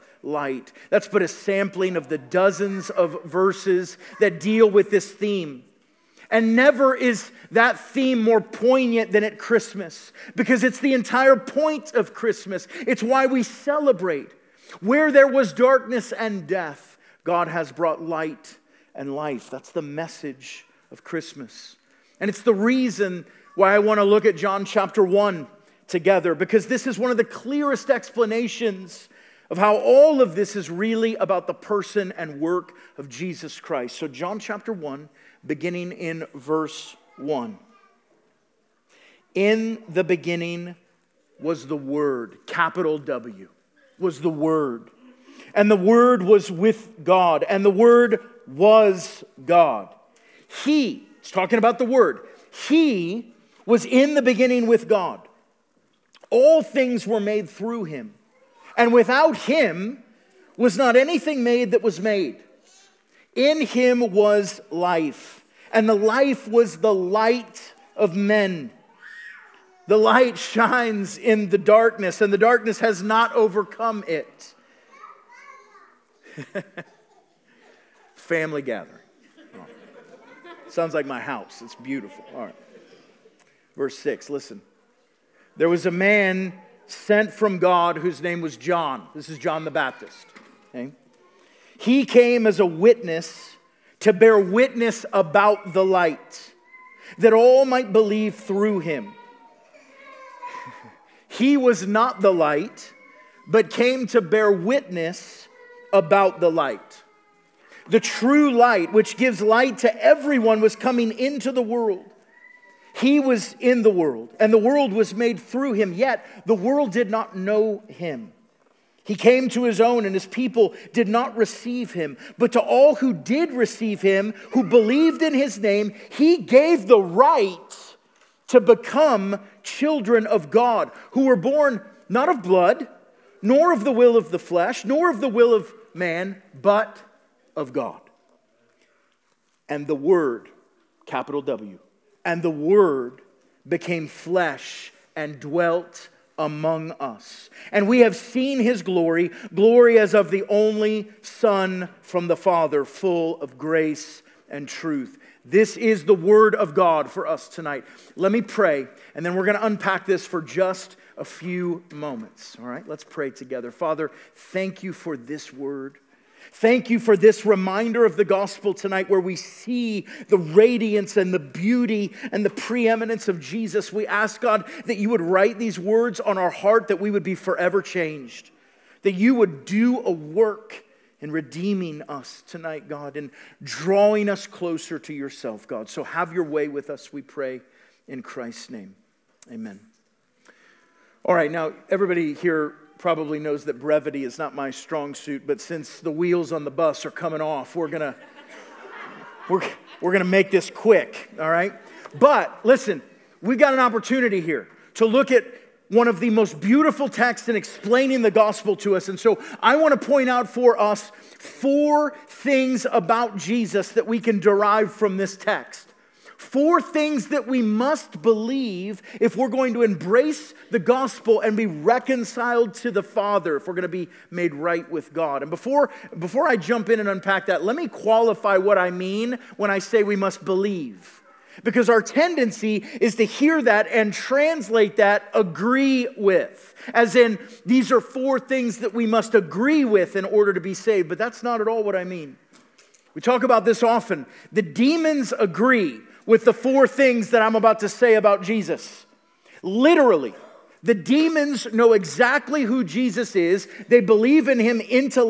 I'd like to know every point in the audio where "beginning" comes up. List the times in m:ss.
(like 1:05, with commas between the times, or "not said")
0:35, 0:40, 0:54.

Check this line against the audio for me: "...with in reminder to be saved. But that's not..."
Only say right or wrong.
wrong.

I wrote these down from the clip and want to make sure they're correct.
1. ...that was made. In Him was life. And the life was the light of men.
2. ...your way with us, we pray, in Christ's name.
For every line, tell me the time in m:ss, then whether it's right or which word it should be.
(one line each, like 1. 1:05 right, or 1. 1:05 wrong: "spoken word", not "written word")
1. 1:01 right
2. 3:06 right.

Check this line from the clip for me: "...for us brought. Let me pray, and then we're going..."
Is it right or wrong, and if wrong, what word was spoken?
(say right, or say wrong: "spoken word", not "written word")
wrong: "tonight", not "brought".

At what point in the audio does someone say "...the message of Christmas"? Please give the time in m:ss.
0:19.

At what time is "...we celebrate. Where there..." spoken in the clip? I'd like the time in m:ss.
0:13.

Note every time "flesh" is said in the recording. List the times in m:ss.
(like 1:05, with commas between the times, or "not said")
2:14, 2:24.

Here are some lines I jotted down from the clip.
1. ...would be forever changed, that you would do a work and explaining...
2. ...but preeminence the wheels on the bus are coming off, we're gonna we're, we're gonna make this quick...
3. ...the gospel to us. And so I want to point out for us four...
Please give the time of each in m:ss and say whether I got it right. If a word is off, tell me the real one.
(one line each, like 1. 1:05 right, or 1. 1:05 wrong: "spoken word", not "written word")
1. 2:57 wrong: "redeeming", not "explaining"
2. 3:15 wrong: "since", not "preeminence"
3. 3:28 right.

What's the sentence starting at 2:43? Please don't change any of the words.
Father, thank you for this word.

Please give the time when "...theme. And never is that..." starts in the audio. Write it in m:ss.
0:05.